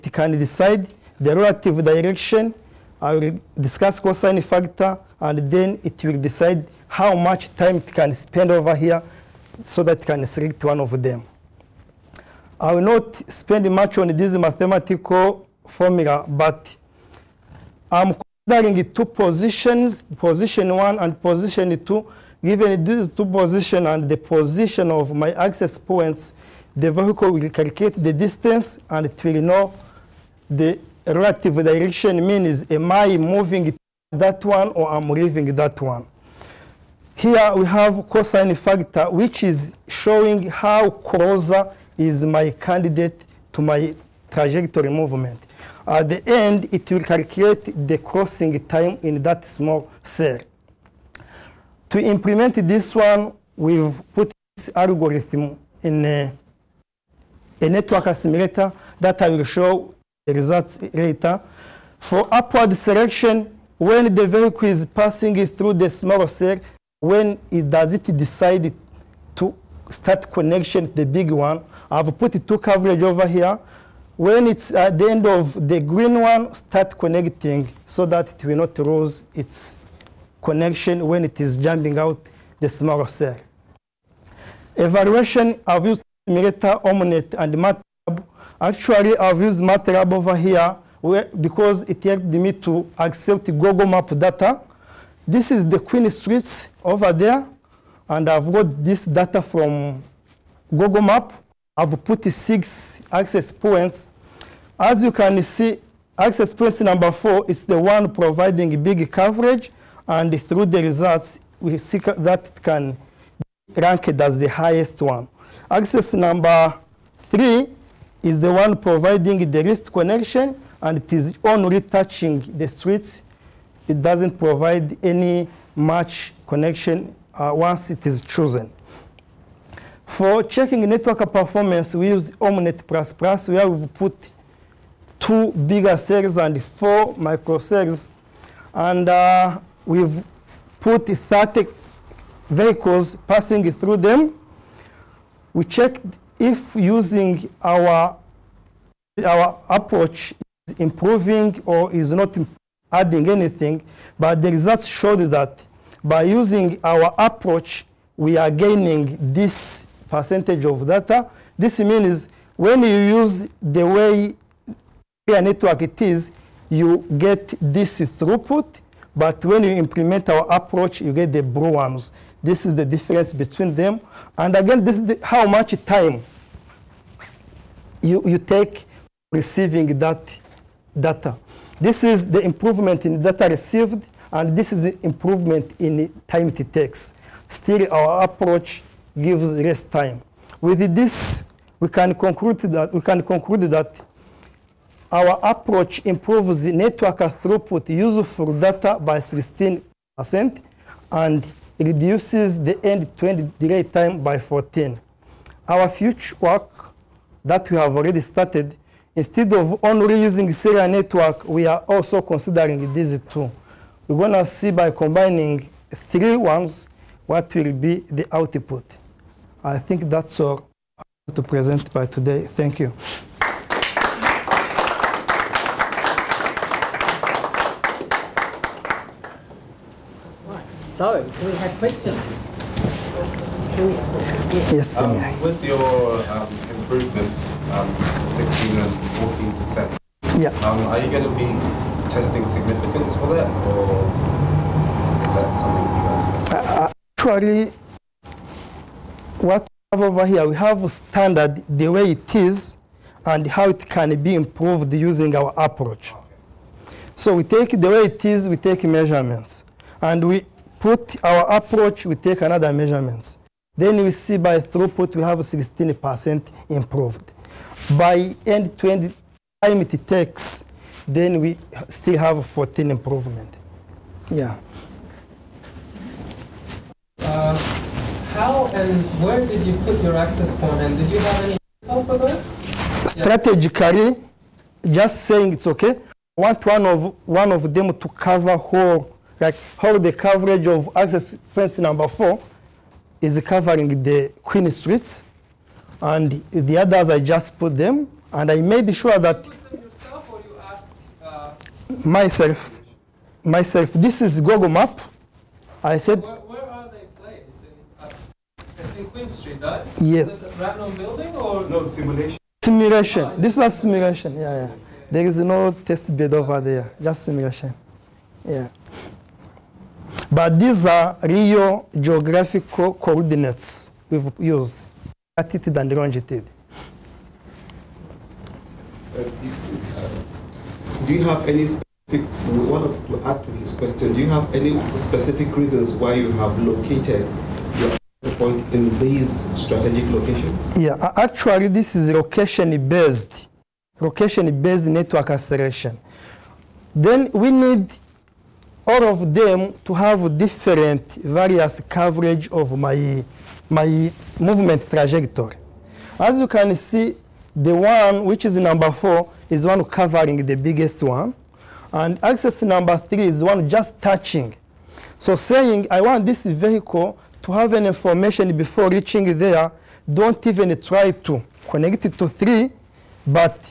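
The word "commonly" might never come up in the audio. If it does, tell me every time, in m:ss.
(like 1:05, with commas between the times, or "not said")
not said.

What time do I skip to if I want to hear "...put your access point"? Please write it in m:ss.
4:39.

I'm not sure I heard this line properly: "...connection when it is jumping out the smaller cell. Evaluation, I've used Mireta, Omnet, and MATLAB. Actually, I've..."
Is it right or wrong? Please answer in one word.
right.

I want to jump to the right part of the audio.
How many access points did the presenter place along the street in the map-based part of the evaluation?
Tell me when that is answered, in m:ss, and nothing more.
1:42.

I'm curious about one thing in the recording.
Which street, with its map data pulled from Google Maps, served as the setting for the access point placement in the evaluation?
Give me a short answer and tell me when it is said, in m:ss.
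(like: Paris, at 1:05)
Queen Street, at 1:35.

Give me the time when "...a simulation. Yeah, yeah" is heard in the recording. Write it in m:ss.
5:13.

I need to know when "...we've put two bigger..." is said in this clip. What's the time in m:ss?
2:13.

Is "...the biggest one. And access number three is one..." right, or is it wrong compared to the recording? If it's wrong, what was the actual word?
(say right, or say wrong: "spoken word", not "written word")
right.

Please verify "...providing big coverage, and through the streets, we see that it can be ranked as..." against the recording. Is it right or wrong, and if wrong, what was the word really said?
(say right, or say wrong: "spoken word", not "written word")
wrong: "results", not "streets".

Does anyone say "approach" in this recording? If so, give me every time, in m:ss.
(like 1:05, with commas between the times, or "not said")
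2:29, 2:37, 2:50, 3:08, 3:15, 4:15, 4:21.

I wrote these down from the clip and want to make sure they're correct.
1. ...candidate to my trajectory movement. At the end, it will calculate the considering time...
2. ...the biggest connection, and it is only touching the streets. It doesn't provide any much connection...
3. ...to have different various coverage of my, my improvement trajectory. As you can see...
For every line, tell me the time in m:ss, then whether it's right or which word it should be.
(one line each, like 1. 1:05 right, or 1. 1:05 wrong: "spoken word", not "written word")
1. 0:42 wrong: "crossing", not "considering"
2. 1:59 wrong: "least", not "biggest"
3. 5:49 wrong: "movement", not "improvement".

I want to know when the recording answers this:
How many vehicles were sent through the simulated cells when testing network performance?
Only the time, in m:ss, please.
2:21.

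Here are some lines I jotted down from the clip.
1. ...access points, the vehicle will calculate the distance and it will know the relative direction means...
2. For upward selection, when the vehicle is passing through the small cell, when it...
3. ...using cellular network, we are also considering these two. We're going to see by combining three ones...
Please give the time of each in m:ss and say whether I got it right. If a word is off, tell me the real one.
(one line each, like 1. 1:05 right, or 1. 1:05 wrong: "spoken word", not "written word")
1. 0:25 right
2. 1:01 right
3. 3:30 right.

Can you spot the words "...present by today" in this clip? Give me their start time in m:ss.
3:41.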